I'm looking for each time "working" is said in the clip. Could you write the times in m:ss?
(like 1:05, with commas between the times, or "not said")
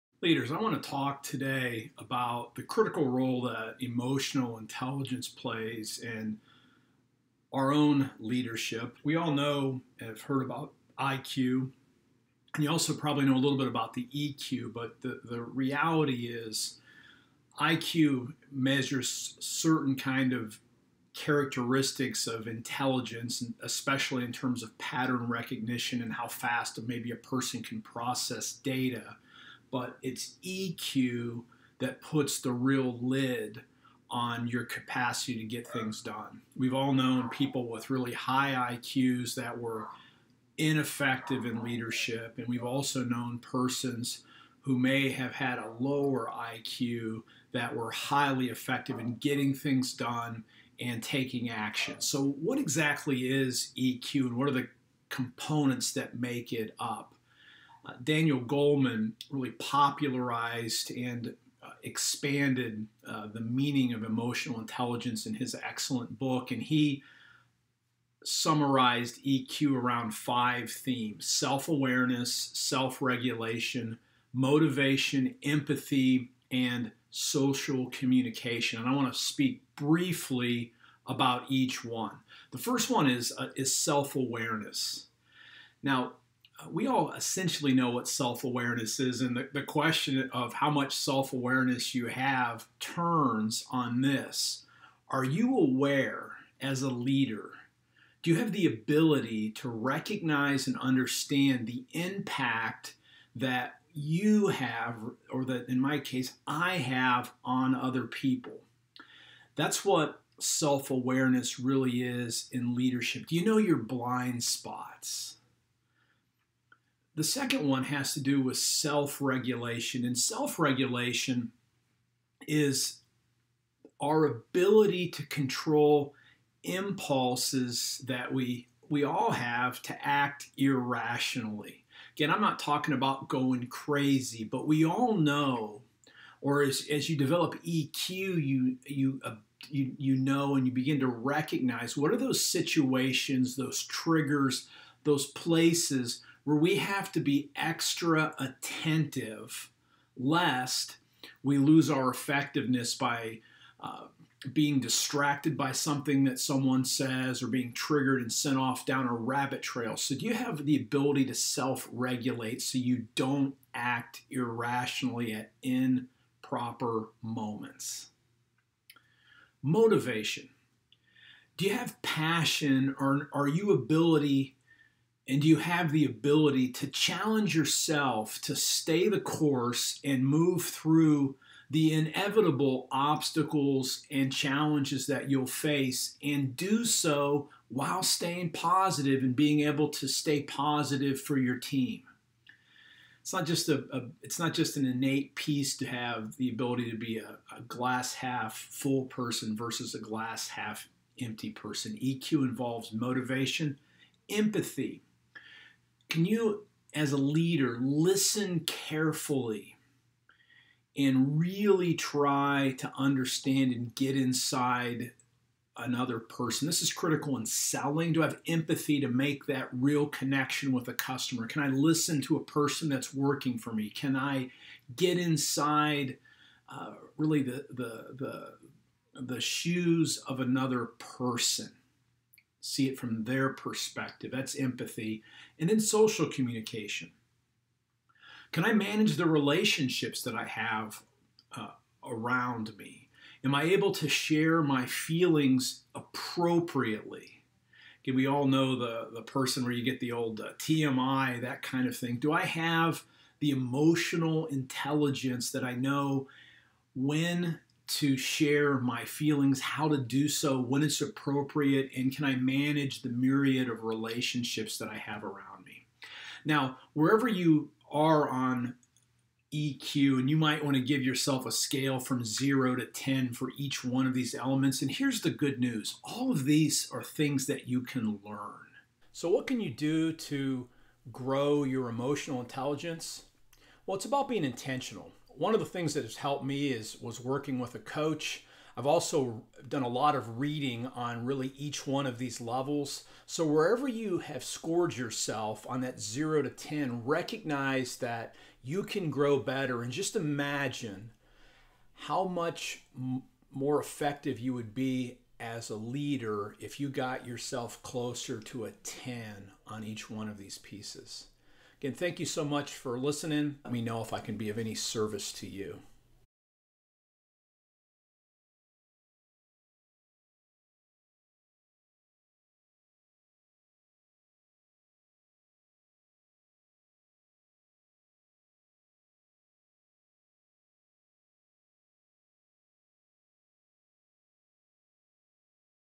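3:43, 4:47.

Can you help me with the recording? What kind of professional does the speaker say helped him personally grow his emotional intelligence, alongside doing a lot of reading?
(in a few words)
a coach.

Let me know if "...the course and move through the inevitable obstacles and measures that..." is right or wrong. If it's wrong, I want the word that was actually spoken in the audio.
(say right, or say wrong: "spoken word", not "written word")
wrong: "challenges", not "measures".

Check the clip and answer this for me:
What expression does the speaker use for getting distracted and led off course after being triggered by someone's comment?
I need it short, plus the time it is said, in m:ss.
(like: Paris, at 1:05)
rabbit trail, at 2:39.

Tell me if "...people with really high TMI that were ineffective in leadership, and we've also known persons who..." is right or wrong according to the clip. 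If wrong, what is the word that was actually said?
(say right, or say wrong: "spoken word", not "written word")
wrong: "IQs", not "TMI".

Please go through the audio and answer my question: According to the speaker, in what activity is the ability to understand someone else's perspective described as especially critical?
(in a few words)
selling.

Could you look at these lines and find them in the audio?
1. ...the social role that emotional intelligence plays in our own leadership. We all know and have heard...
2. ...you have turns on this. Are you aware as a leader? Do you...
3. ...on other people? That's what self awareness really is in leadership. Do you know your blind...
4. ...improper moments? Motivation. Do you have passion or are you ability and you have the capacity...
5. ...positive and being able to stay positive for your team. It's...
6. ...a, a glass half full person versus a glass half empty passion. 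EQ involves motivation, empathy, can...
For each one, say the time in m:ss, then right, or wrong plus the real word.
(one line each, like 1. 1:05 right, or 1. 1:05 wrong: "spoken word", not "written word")
1. 0:02 wrong: "critical", not "social"
2. 1:31 right
3. 1:47 right
4. 2:45 wrong: "ability", not "capacity"
5. 3:08 right
6. 3:17 wrong: "person", not "passion".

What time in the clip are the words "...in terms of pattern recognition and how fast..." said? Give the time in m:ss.
0:24.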